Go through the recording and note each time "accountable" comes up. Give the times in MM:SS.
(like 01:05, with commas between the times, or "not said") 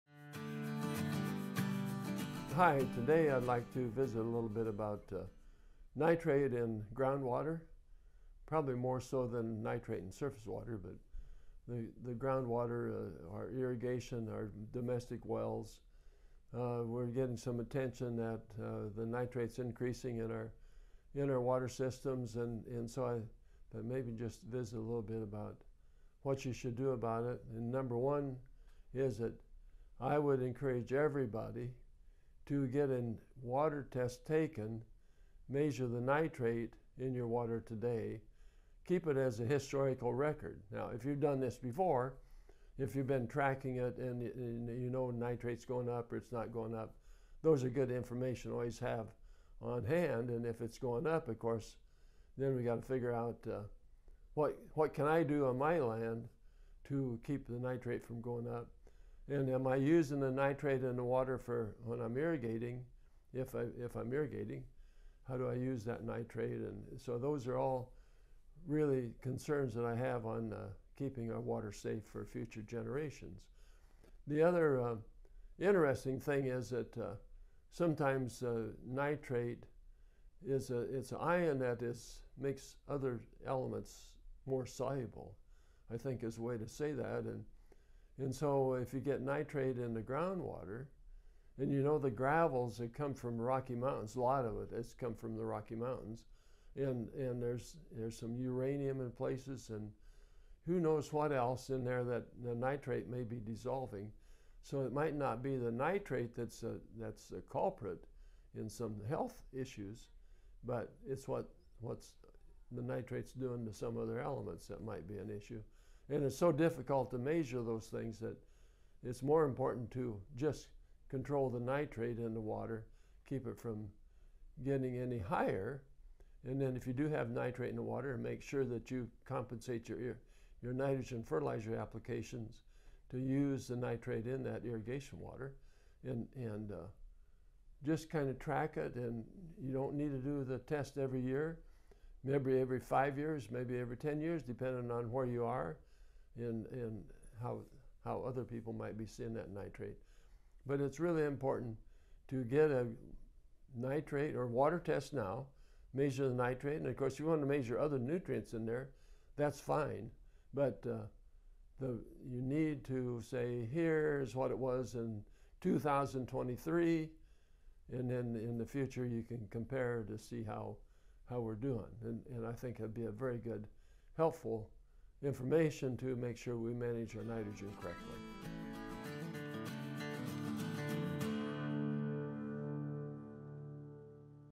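not said.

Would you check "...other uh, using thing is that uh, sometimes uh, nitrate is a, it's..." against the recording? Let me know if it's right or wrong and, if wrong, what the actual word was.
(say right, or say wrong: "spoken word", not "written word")
wrong: "interesting", not "using".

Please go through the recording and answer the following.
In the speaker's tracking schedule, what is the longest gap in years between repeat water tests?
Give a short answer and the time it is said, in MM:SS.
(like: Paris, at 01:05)
10, at 02:23.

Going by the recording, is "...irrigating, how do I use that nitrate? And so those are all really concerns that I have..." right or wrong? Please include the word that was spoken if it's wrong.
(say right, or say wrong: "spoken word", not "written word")
right.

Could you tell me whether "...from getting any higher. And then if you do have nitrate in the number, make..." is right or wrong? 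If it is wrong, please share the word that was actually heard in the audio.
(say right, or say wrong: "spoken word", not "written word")
wrong: "water", not "number".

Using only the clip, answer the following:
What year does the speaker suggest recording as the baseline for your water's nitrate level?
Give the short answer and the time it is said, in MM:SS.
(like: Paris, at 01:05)
2023, at 02:45.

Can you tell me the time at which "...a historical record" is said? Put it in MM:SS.
00:39.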